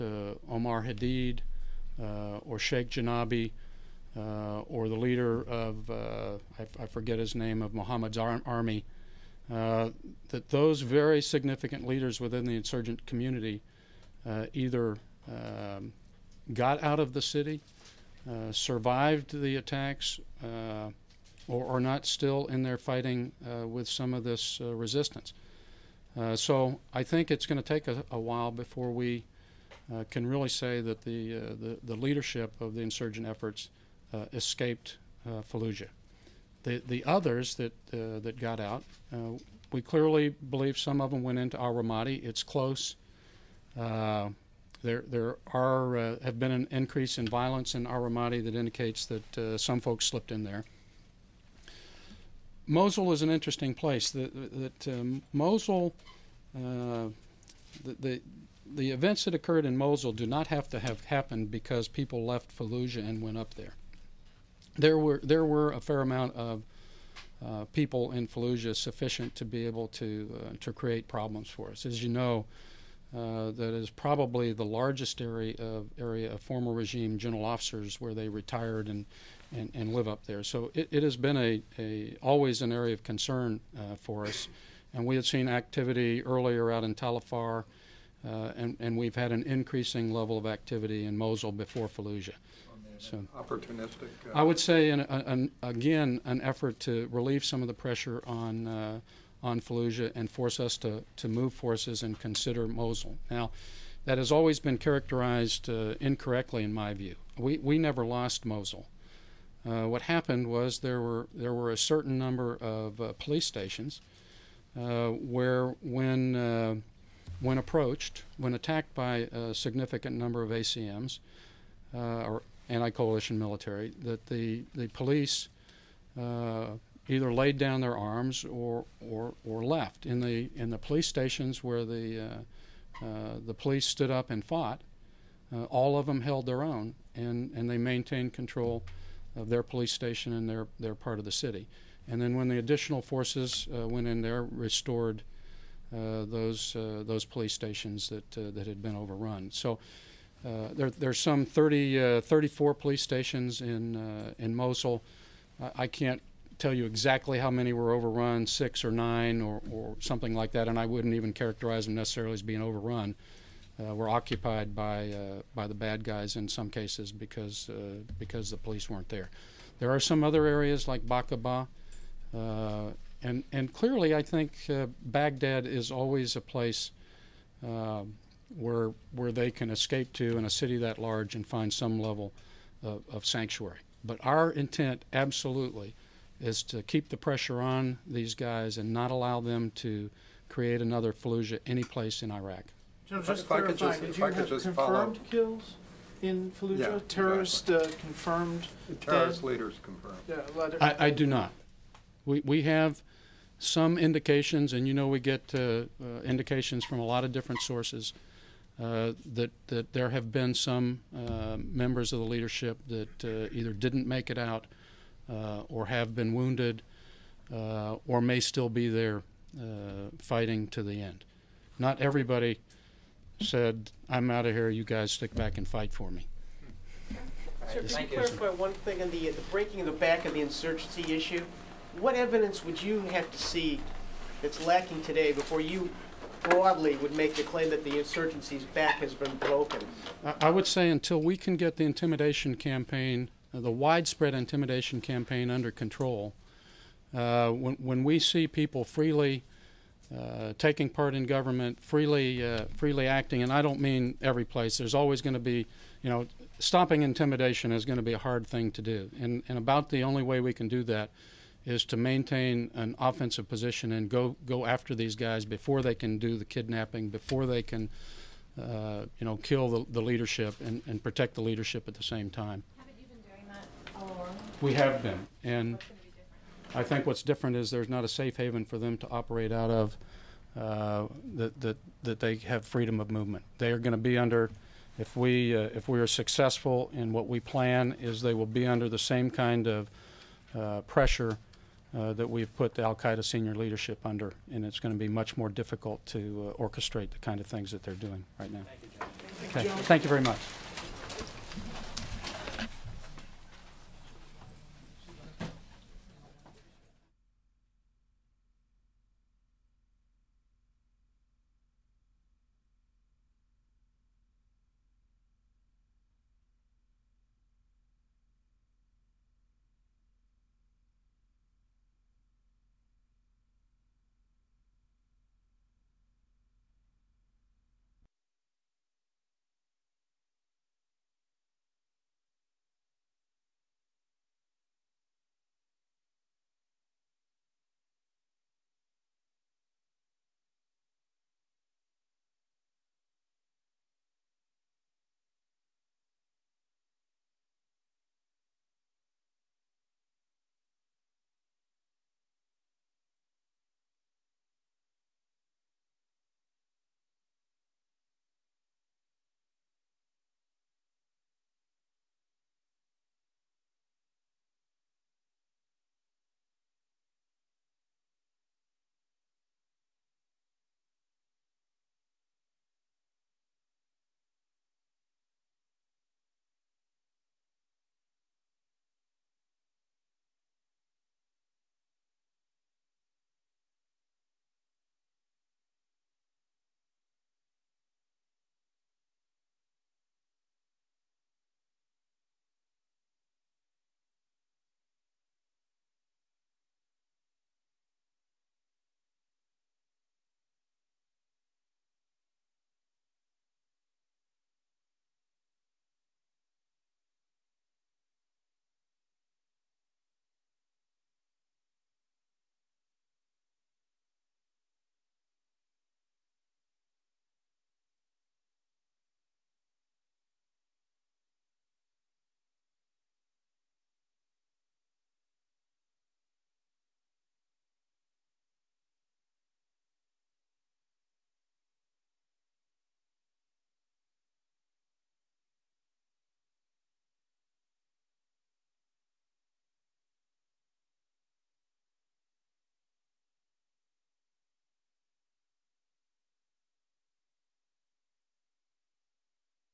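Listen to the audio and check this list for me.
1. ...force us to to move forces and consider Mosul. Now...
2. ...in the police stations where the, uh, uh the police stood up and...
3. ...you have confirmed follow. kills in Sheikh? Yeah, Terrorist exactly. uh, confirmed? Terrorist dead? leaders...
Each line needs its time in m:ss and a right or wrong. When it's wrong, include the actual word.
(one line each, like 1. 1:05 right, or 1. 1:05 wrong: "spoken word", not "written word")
1. 1:40 right
2. 2:10 right
3. 3:14 wrong: "Fallujah", not "Sheikh".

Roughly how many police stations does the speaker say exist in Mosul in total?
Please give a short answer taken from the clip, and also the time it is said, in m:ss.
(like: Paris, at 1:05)
34, at 2:32.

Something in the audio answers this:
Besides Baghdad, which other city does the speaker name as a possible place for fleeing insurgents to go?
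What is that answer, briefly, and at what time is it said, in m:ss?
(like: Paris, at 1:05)
Baqubah, at 2:51.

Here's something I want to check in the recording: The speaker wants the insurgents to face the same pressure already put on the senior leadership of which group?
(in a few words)
Al Qaeda.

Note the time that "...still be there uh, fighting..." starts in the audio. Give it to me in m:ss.
3:38.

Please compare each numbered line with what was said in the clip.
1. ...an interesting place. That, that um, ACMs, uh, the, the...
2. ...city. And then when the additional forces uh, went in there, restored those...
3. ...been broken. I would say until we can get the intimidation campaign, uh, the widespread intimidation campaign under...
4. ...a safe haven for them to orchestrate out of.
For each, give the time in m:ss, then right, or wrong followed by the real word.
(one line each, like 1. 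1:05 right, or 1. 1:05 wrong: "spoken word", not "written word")
1. 0:53 wrong: "Mosul", not "ACMs"
2. 2:21 right
3. 3:59 right
4. 4:38 wrong: "operate", not "orchestrate".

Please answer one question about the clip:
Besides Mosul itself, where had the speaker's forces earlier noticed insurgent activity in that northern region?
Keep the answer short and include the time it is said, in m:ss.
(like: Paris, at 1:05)
Talafar, at 1:26.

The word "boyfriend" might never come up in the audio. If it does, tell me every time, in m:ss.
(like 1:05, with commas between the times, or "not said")
not said.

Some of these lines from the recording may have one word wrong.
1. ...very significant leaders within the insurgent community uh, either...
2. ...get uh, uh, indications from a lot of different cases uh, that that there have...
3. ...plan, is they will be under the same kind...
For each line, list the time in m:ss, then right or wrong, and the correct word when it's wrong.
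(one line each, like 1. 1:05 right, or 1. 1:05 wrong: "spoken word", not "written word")
1. 0:10 right
2. 3:25 wrong: "sources", not "cases"
3. 4:47 right.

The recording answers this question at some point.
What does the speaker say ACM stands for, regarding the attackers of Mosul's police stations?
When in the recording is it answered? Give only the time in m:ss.
2:02.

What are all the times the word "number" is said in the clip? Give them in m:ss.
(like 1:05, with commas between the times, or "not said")
1:52, 2:00.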